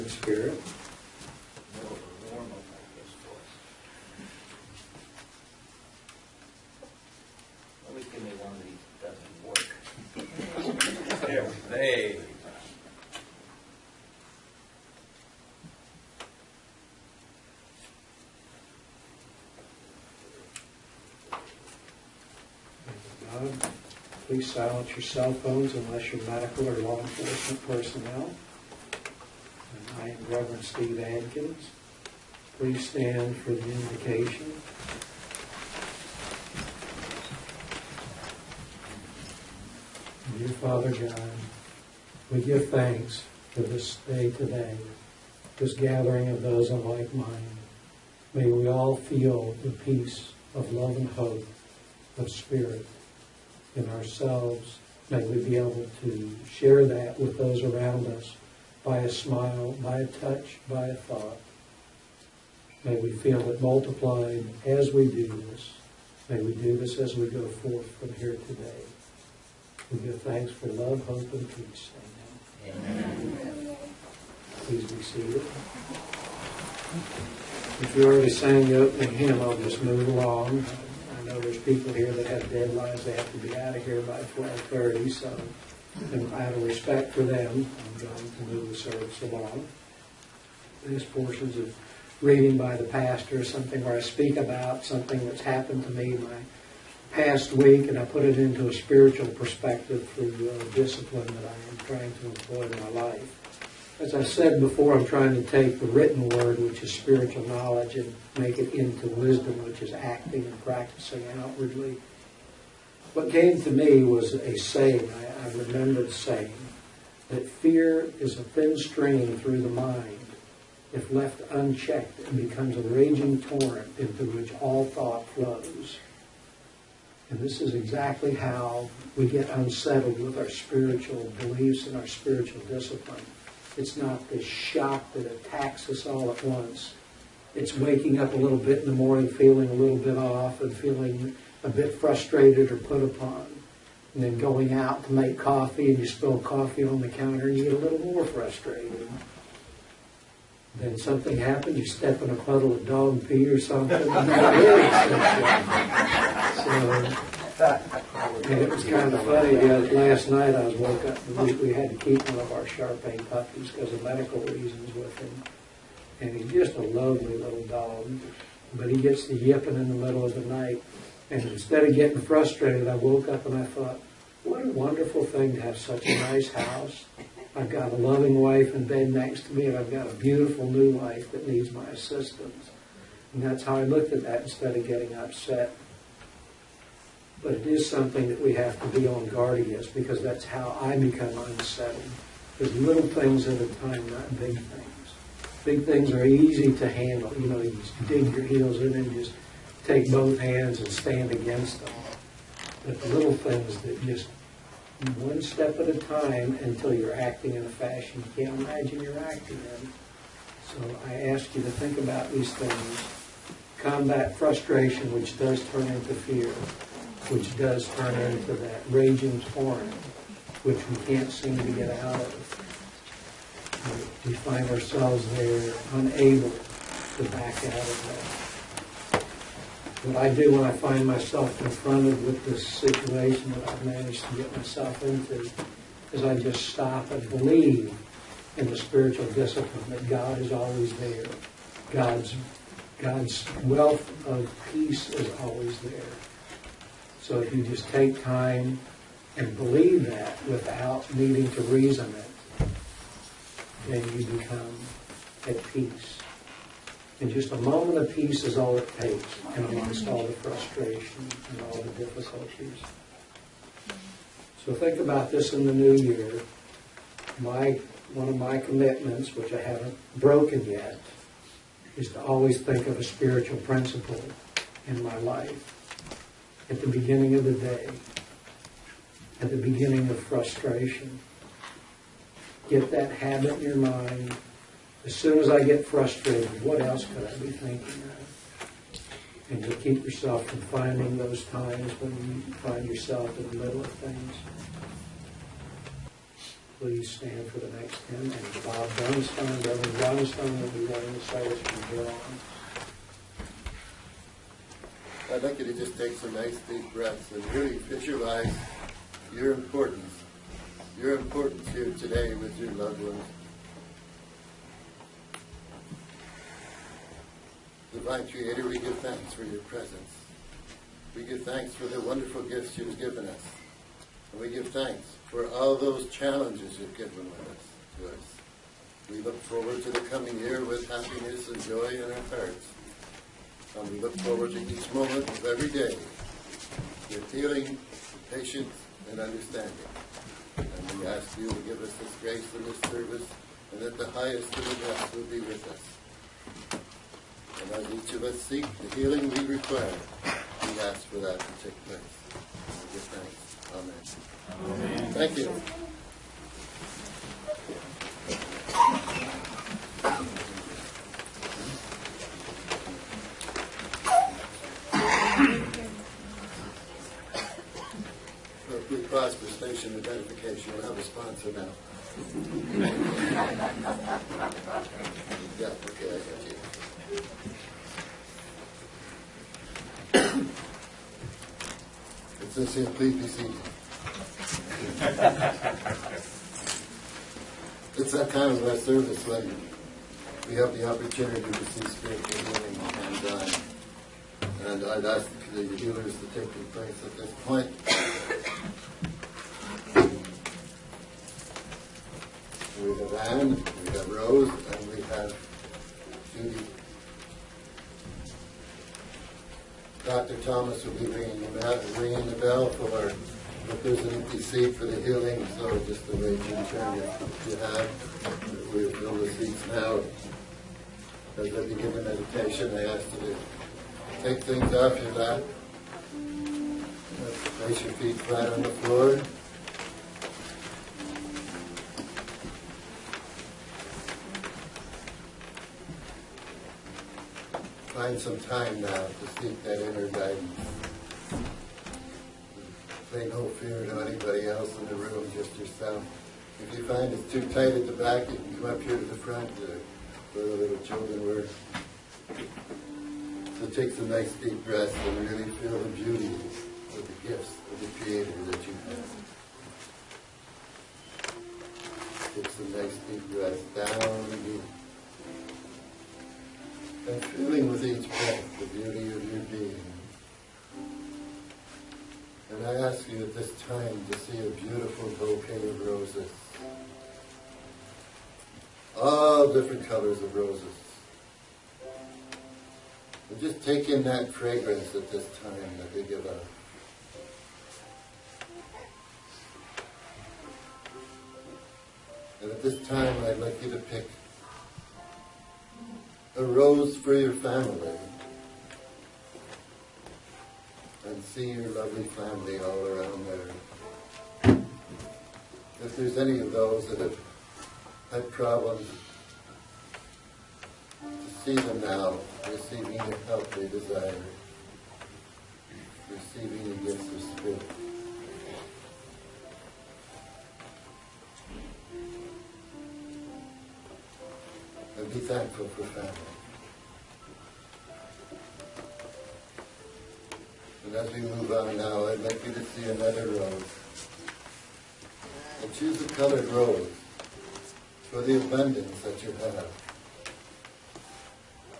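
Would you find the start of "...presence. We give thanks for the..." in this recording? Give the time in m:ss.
5:19.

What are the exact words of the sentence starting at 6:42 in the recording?
We have Anne, we have Rose, and we have Judy.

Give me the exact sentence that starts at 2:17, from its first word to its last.
It's waking up a little bit in the morning, feeling a little bit off and feeling a bit frustrated or put upon.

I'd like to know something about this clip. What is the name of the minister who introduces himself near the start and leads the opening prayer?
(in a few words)
Steve Adkins.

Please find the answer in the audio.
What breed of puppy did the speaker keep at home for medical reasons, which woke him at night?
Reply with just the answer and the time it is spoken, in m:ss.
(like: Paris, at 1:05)
Shar Pei, at 2:42.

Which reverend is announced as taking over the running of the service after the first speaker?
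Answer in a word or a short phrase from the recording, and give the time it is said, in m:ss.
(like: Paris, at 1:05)
Bob Bernstein, at 4:58.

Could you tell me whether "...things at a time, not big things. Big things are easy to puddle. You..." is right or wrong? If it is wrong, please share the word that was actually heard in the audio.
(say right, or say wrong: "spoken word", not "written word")
wrong: "handle", not "puddle".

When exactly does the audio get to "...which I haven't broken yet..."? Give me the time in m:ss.
4:29.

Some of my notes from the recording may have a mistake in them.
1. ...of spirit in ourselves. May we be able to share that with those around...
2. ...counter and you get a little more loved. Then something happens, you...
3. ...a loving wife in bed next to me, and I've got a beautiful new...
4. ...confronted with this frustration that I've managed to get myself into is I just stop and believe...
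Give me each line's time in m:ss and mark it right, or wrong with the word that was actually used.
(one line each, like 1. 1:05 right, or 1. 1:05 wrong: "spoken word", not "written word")
1. 0:52 right
2. 2:27 wrong: "frustrated", not "loved"
3. 2:57 right
4. 3:51 wrong: "situation", not "frustration".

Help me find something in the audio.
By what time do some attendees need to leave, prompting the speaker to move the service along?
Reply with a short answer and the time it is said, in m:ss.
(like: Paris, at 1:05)
12:30, at 1:24.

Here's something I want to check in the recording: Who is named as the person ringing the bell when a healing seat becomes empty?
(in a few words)
Dr. Thomas.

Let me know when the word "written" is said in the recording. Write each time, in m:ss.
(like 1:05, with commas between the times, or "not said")
1:45.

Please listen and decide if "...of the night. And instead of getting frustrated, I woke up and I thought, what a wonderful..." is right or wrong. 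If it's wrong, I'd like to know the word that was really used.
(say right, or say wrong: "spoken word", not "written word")
right.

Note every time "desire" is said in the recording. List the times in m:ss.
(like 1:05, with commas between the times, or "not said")
8:33.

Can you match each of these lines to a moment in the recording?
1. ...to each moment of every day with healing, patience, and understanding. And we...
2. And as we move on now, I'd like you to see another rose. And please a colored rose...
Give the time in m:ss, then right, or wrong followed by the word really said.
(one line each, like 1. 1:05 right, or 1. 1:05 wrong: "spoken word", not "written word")
1. 5:34 right
2. 8:50 wrong: "choose", not "please".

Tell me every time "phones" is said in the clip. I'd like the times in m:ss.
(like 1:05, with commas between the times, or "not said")
0:25.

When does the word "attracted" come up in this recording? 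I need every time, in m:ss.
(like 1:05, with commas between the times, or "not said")
not said.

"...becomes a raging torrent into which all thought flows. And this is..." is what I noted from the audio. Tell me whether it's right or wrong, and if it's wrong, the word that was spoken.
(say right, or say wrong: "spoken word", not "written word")
right.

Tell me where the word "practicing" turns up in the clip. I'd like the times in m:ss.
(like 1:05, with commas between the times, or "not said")
1:50.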